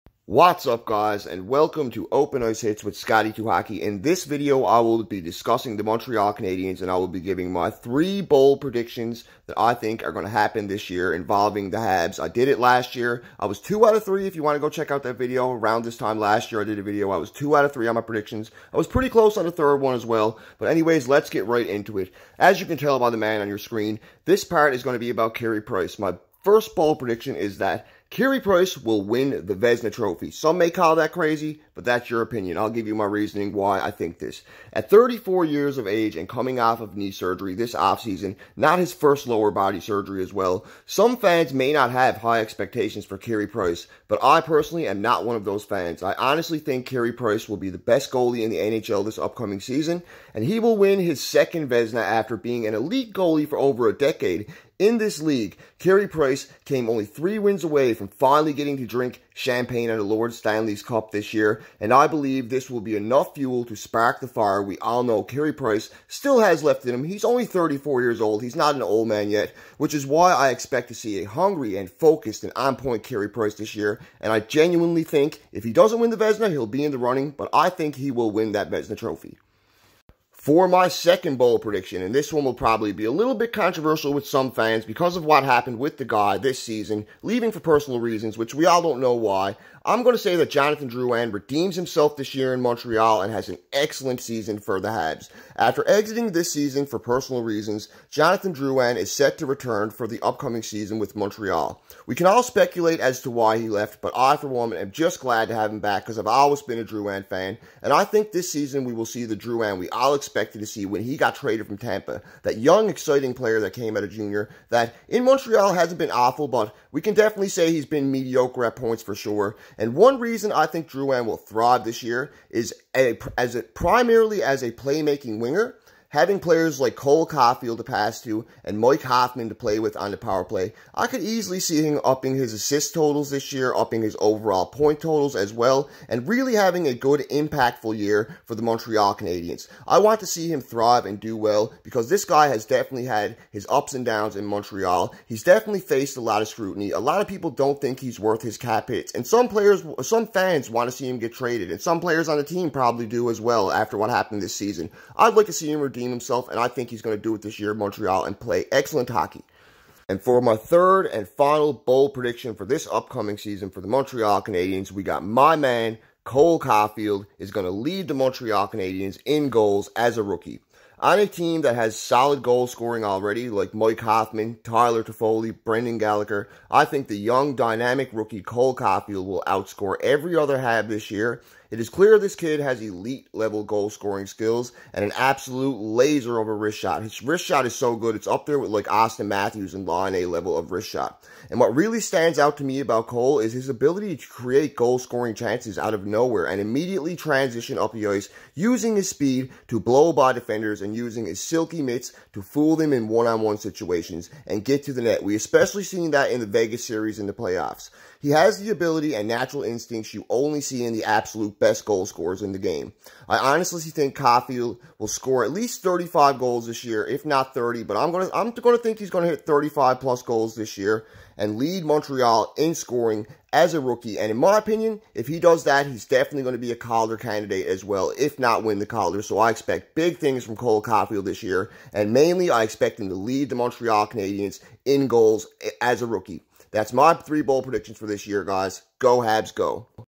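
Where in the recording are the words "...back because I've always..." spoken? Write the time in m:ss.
1:45.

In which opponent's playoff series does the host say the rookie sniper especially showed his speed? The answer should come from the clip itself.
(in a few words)
Vegas.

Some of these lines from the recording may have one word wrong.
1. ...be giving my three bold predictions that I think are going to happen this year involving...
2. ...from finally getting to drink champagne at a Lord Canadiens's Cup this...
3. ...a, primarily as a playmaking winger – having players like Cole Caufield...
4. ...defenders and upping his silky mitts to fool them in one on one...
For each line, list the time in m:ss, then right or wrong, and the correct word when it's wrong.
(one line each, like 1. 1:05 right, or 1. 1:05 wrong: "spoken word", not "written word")
1. 0:07 right
2. 0:57 wrong: "Stanley", not "Canadiens"
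3. 2:03 right
4. 3:20 wrong: "using", not "upping".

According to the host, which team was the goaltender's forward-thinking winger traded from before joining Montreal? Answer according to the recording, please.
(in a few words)
Tampa.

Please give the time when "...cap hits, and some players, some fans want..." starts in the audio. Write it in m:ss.
2:28.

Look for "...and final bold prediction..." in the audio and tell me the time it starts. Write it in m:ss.
2:41.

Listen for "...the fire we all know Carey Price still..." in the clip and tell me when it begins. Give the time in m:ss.
1:04.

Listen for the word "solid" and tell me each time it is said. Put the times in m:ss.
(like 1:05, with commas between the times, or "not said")
2:51.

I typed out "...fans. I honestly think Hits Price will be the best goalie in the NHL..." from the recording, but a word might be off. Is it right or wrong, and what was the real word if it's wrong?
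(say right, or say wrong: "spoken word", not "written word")
wrong: "Carey", not "Hits".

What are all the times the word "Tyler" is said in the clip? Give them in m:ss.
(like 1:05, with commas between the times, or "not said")
2:54.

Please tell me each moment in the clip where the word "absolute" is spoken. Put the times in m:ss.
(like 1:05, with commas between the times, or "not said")
3:05, 3:31.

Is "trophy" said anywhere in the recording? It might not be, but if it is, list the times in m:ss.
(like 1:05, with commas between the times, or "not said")
0:29, 1:18.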